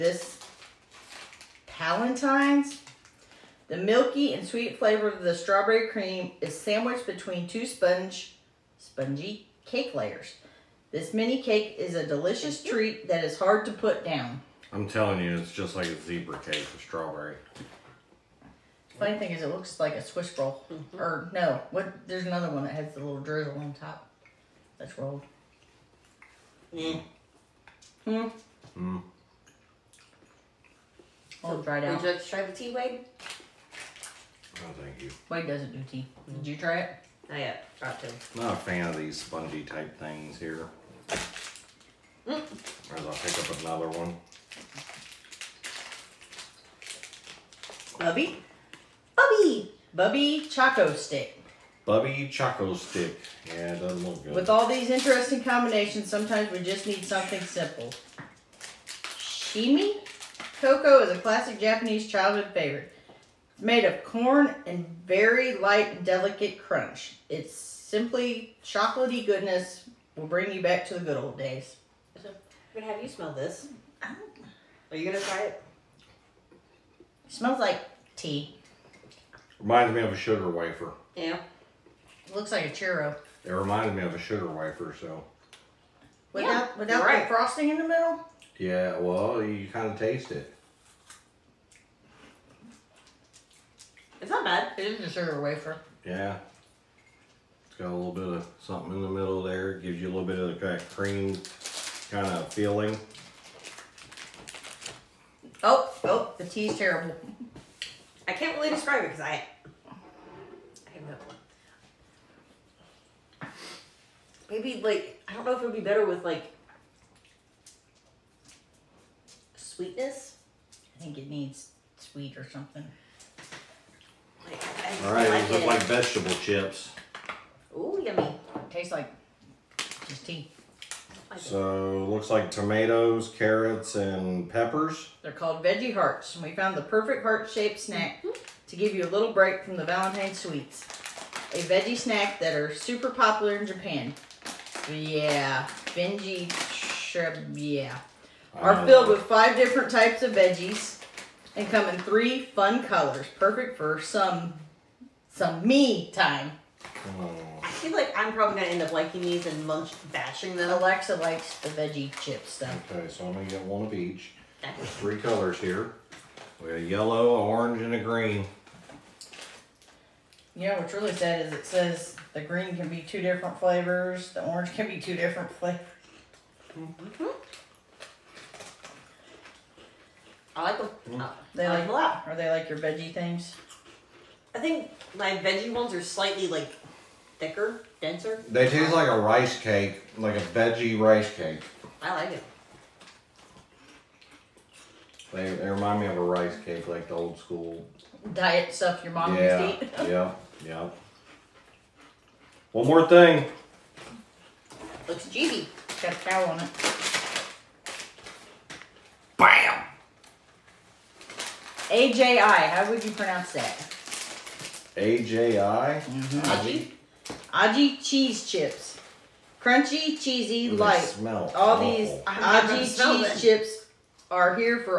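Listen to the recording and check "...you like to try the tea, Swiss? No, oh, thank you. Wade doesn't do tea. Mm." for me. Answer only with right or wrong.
wrong.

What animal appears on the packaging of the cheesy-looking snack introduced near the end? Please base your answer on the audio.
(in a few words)
cow.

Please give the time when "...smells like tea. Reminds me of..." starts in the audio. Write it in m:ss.
1:17.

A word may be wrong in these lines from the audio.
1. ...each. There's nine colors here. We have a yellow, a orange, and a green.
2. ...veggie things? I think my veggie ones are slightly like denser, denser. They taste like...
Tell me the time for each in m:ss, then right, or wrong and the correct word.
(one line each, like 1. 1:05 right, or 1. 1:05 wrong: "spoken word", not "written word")
1. 2:43 wrong: "three", not "nine"
2. 3:02 wrong: "thicker", not "denser".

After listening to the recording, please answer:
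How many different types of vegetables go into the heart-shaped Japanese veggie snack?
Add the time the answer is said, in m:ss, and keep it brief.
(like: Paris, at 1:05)
5, at 2:29.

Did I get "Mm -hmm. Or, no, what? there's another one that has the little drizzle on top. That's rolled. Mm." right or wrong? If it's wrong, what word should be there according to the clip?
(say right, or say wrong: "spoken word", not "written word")
right.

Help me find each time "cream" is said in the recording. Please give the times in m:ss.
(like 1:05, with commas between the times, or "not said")
0:05, 1:40.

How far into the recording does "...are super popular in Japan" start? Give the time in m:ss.
2:22.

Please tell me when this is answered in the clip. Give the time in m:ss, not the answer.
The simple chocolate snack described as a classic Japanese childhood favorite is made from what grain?
1:03.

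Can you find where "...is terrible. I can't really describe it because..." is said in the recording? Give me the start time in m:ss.
1:46.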